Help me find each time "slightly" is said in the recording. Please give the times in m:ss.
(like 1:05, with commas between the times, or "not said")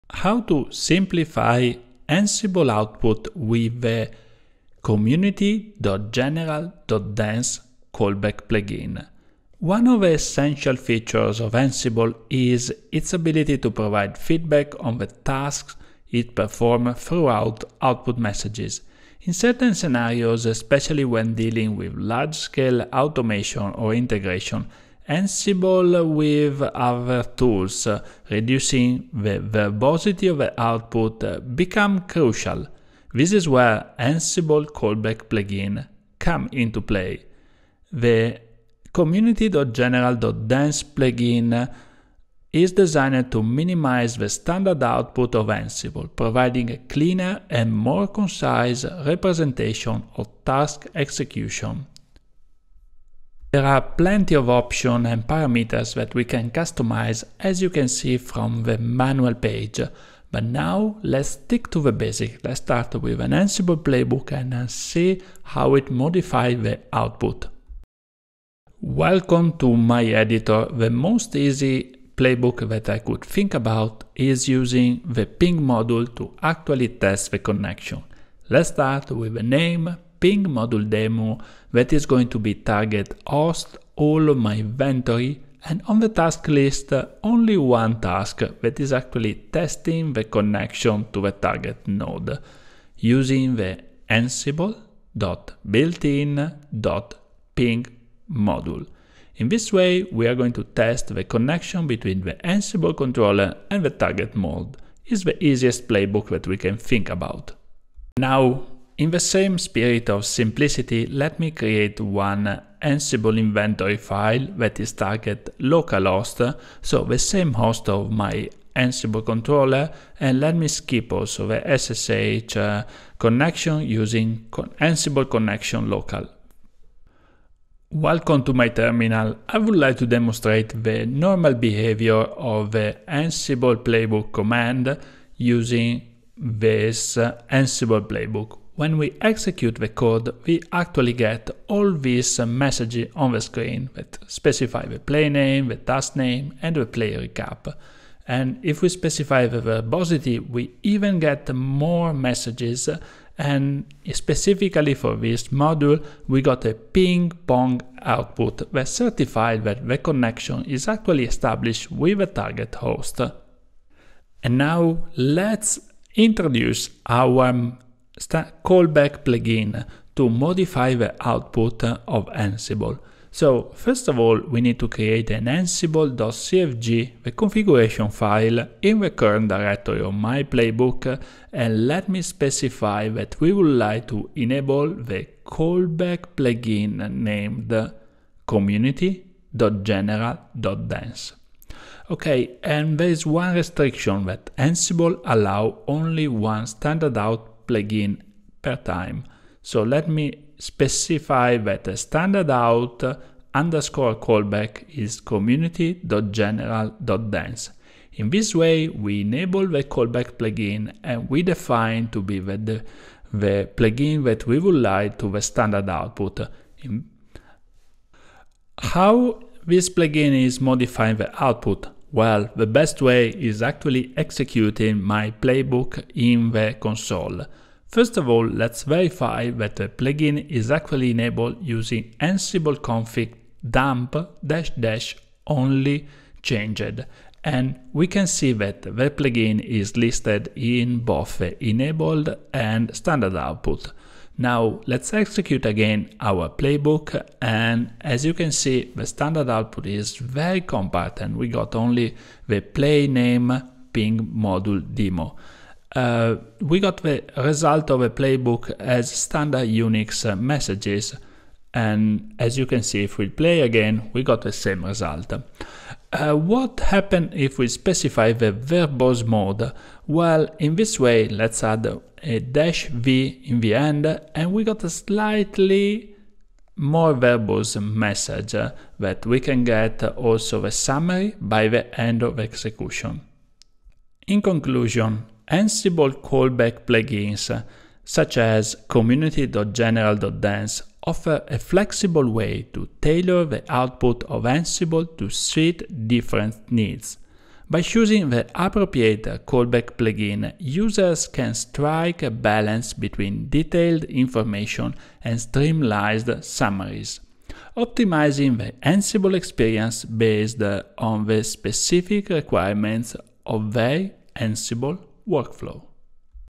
4:34.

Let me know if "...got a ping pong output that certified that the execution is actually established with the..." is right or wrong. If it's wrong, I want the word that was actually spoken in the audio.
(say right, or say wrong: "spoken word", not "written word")
wrong: "connection", not "execution".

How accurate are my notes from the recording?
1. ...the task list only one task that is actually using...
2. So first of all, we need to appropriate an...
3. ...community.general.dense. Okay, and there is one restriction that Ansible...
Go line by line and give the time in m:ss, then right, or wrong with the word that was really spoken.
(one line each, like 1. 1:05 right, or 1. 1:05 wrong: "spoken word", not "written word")
1. 1:25 wrong: "testing", not "using"
2. 2:53 wrong: "create", not "appropriate"
3. 3:08 right.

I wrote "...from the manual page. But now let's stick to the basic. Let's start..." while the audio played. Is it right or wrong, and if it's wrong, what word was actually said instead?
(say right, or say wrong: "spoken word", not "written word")
right.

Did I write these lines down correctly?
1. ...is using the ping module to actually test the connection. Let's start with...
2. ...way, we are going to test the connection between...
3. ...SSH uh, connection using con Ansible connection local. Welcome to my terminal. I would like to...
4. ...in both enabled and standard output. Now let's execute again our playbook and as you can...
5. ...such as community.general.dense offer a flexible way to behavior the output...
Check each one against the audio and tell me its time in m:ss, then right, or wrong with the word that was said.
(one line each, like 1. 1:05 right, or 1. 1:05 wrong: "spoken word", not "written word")
1. 1:14 right
2. 1:39 right
3. 2:01 right
4. 4:00 right
5. 4:48 wrong: "tailor", not "behavior".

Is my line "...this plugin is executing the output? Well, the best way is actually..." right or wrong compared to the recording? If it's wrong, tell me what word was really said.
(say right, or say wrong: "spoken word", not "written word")
wrong: "modifying", not "executing".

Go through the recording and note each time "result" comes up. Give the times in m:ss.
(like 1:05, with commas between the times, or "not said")
4:17, 4:24.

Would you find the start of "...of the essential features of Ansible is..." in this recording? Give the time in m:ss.
0:09.